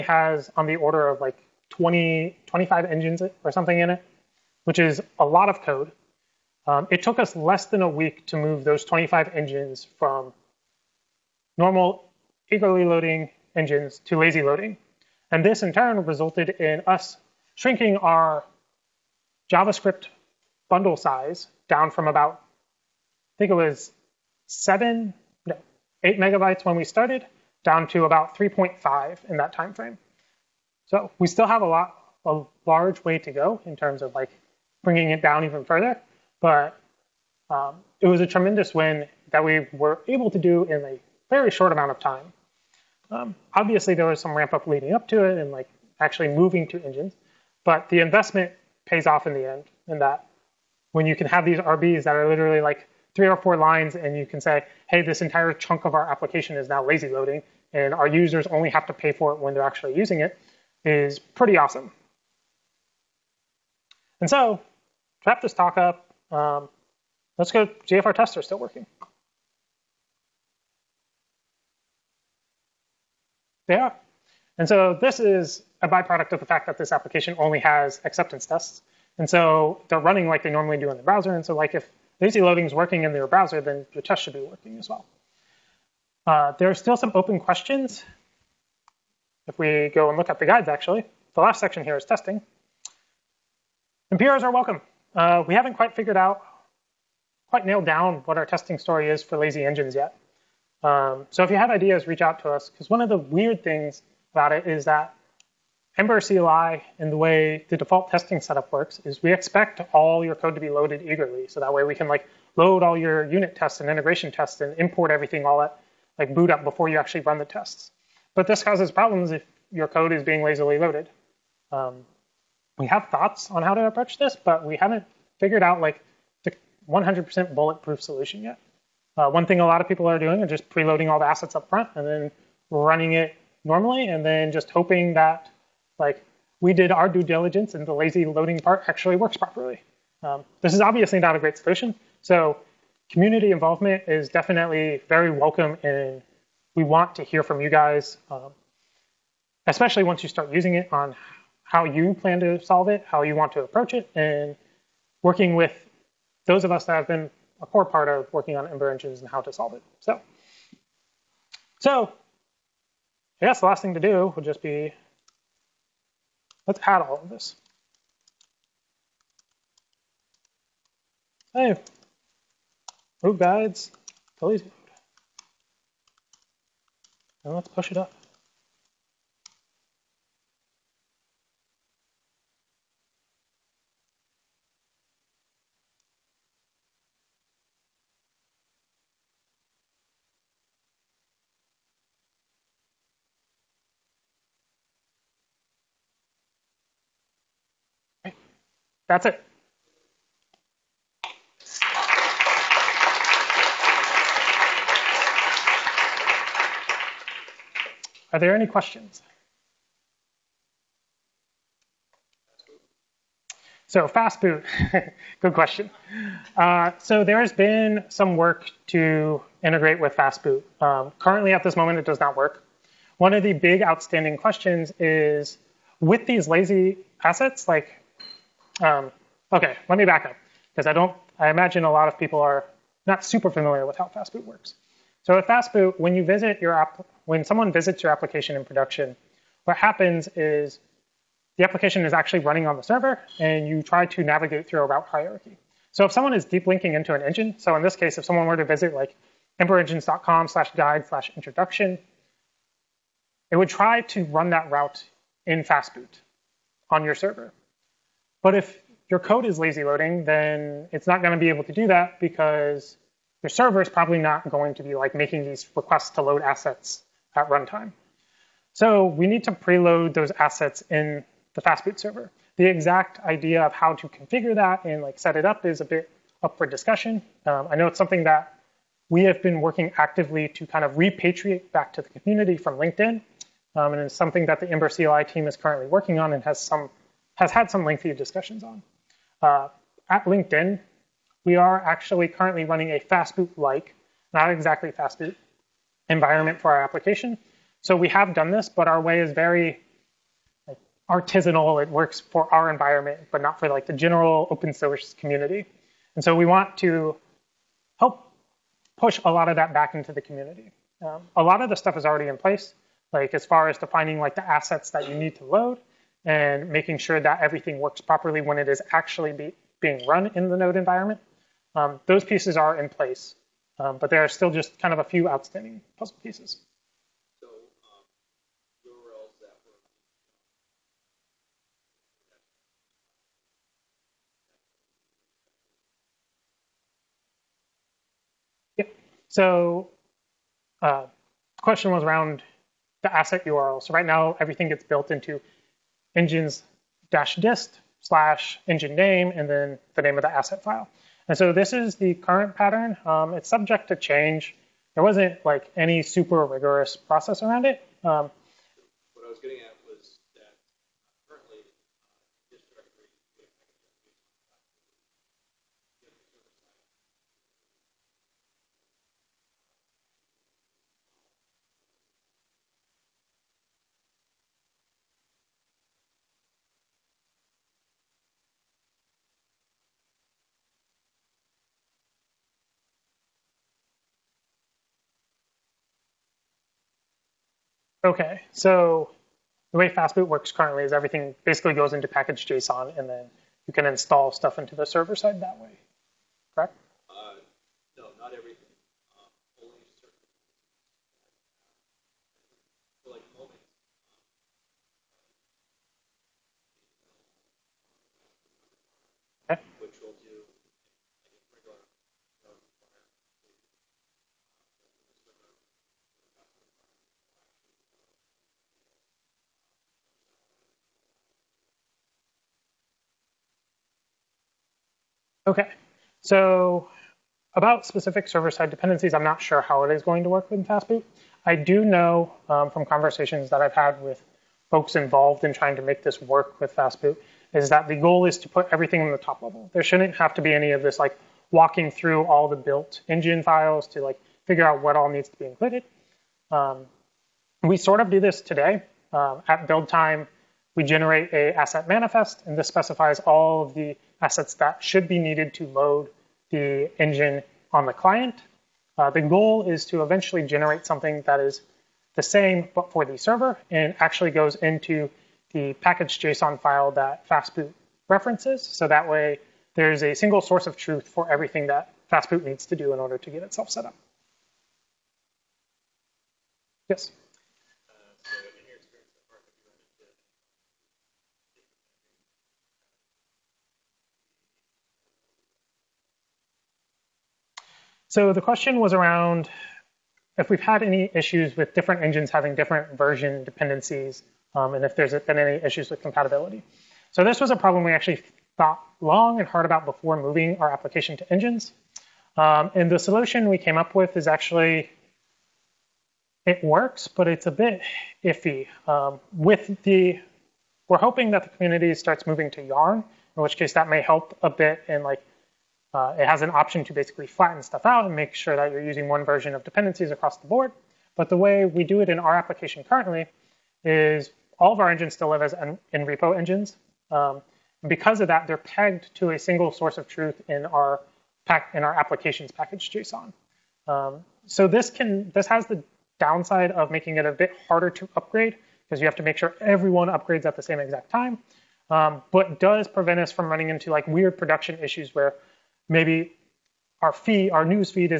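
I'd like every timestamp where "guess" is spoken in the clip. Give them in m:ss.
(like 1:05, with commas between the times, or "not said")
2:43.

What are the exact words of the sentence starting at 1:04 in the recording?
And so, to wrap this talk up, um, let's go GFR tester, still working.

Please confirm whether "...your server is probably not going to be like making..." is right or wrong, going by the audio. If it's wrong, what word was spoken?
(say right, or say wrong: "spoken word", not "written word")
right.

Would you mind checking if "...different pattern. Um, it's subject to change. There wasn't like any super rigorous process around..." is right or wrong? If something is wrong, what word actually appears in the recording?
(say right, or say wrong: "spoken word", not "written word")
wrong: "current", not "different".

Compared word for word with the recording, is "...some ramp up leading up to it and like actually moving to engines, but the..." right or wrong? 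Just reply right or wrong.
right.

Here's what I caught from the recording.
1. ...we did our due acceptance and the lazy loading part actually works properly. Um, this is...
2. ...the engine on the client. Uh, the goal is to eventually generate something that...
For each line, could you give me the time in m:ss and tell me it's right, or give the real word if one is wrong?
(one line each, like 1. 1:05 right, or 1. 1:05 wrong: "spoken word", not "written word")
1. 2:16 wrong: "diligence", not "acceptance"
2. 7:36 right.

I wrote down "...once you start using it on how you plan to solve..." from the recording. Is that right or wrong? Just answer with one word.
right.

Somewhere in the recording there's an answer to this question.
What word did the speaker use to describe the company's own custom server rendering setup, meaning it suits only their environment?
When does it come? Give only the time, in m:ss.
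5:01.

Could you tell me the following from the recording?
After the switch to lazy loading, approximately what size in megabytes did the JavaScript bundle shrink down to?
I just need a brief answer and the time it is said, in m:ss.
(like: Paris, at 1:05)
3.5, at 0:28.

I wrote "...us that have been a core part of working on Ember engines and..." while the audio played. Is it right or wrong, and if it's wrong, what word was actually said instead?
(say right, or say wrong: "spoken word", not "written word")
right.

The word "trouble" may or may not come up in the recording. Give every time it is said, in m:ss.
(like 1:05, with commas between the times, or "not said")
not said.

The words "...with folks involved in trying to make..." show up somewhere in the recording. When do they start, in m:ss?
7:14.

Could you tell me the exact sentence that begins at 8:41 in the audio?
But the way we do it in our application currently is all of our engines still live as in, in repo engines.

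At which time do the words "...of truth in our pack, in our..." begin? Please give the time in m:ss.
8:49.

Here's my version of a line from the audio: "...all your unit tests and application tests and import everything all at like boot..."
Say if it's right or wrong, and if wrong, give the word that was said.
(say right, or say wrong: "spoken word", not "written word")
wrong: "integration", not "application".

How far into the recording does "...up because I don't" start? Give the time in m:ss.
3:50.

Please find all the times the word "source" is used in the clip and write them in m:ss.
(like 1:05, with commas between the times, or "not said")
5:04, 7:50, 8:49.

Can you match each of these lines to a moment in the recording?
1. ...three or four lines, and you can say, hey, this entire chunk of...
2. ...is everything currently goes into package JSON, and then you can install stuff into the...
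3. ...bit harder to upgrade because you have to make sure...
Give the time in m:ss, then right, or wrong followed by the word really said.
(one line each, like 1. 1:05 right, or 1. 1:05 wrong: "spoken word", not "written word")
1. 0:53 right
2. 6:30 wrong: "basically", not "currently"
3. 8:57 right.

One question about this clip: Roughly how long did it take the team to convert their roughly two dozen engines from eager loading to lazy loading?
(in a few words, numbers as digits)
less than a week.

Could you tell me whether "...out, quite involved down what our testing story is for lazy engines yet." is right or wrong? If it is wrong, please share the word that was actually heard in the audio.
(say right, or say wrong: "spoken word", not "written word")
wrong: "nailed", not "involved".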